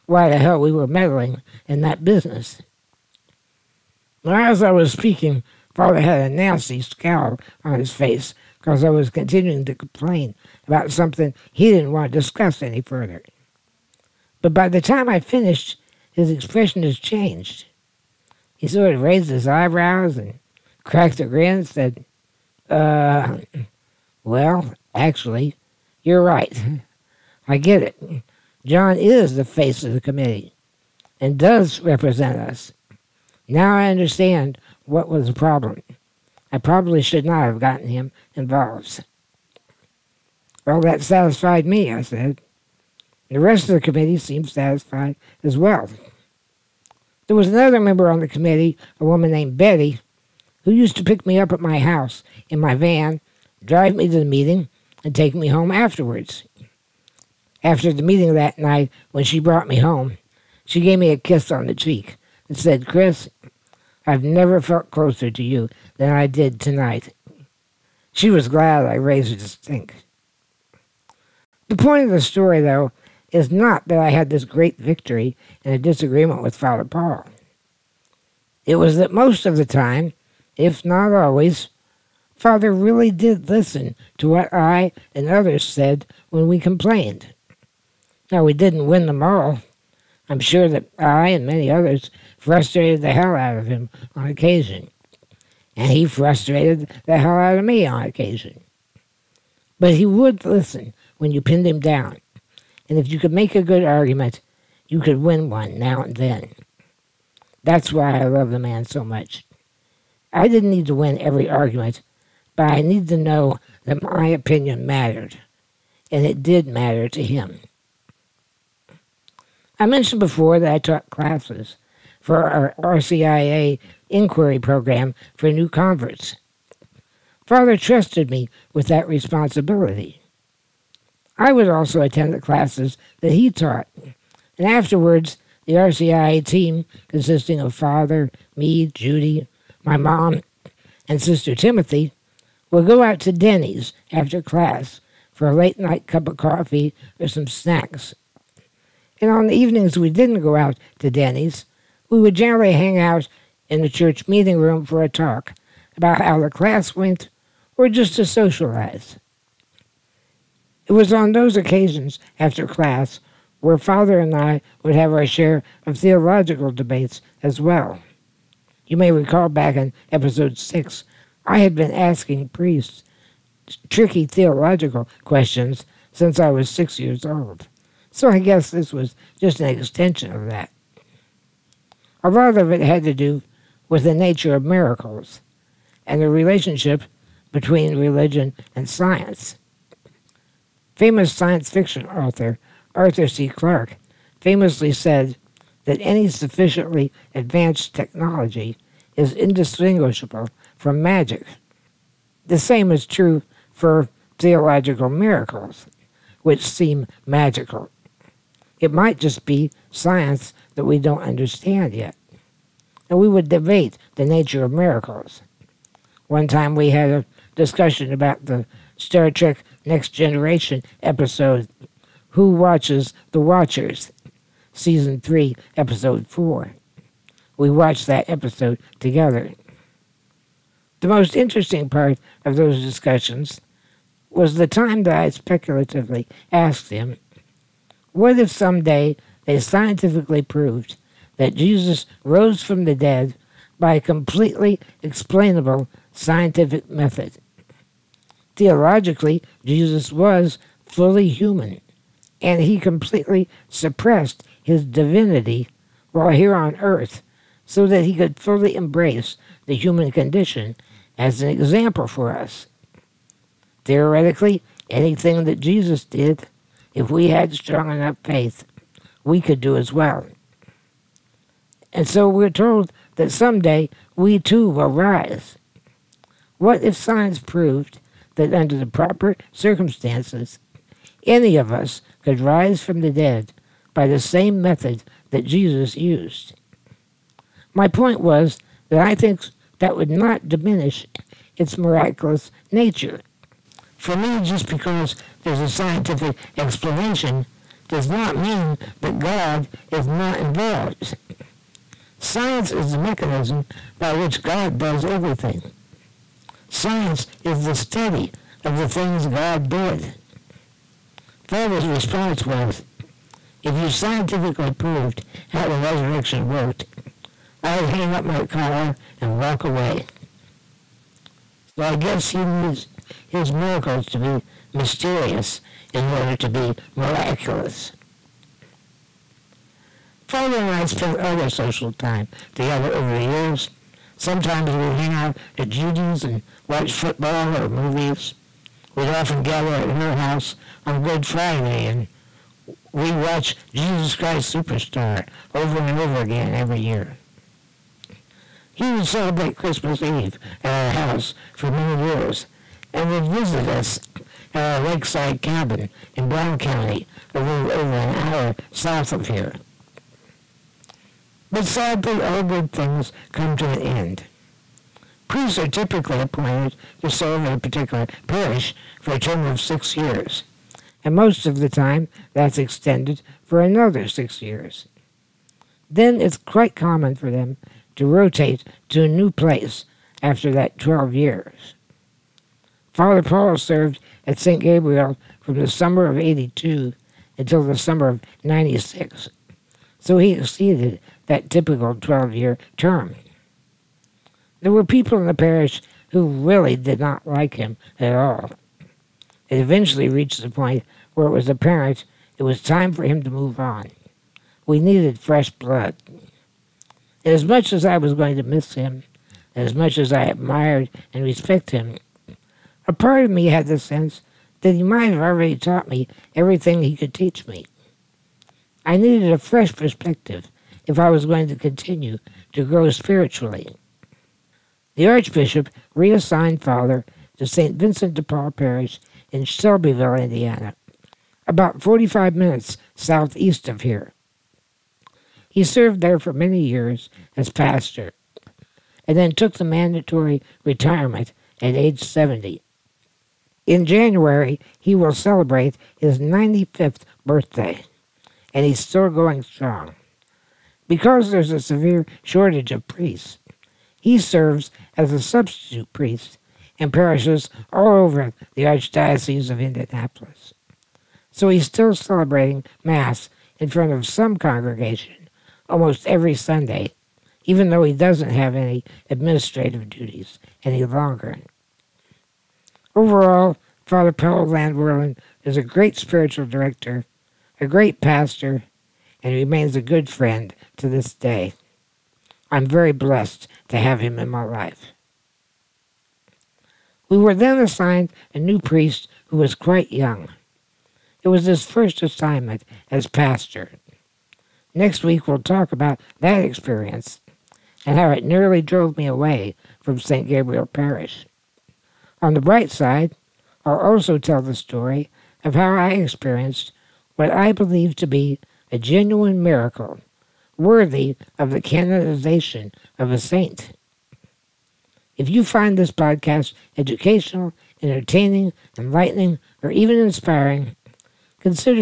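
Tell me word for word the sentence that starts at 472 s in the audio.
Overall, Father Paul Landwerlen is a great spiritual director, a great pastor, and remains a good friend to this day.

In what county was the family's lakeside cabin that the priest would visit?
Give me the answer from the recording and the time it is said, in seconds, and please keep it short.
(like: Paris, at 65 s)
Brown County, at 356 s.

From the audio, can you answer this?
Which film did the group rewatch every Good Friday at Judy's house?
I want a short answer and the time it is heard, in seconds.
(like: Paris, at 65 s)
Jesus Christ Superstar, at 343 s.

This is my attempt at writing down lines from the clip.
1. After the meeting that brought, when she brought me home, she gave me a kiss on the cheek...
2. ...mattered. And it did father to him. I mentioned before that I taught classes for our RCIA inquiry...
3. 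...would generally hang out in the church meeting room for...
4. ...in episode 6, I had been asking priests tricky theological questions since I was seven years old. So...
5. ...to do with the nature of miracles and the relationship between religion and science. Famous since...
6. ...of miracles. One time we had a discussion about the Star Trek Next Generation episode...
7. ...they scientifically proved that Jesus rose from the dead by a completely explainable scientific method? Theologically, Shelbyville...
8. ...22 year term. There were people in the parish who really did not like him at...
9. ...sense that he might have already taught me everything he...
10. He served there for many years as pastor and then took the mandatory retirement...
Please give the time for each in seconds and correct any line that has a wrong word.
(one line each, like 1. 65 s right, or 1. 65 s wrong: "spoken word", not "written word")
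1. 57 s wrong: "night", not "brought"
2. 114 s wrong: "matter", not "father"
3. 152 s right
4. 169 s wrong: "six", not "seven"
5. 183 s wrong: "science", not "since"
6. 214 s right
7. 239 s wrong: "Jesus", not "Shelbyville"
8. 391 s wrong: "12", not "22"
9. 413 s right
10. 435 s right.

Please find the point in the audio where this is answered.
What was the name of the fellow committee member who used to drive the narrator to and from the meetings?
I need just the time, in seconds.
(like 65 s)
49 s.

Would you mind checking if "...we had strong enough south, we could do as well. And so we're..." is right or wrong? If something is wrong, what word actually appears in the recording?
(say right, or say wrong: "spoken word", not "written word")
wrong: "faith", not "south".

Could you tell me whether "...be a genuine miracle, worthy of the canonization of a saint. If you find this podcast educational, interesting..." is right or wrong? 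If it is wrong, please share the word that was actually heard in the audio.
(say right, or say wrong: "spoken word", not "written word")
wrong: "entertaining", not "interesting".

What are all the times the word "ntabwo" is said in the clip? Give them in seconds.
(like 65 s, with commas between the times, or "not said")
not said.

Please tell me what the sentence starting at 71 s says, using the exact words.
The point of the story, though, is not that I had this great victory in a disagreement with Father Paul.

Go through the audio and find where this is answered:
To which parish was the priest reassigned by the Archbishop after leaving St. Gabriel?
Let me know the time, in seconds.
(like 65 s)
427 s.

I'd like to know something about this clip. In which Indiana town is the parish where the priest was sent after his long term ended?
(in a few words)
Shelbyville.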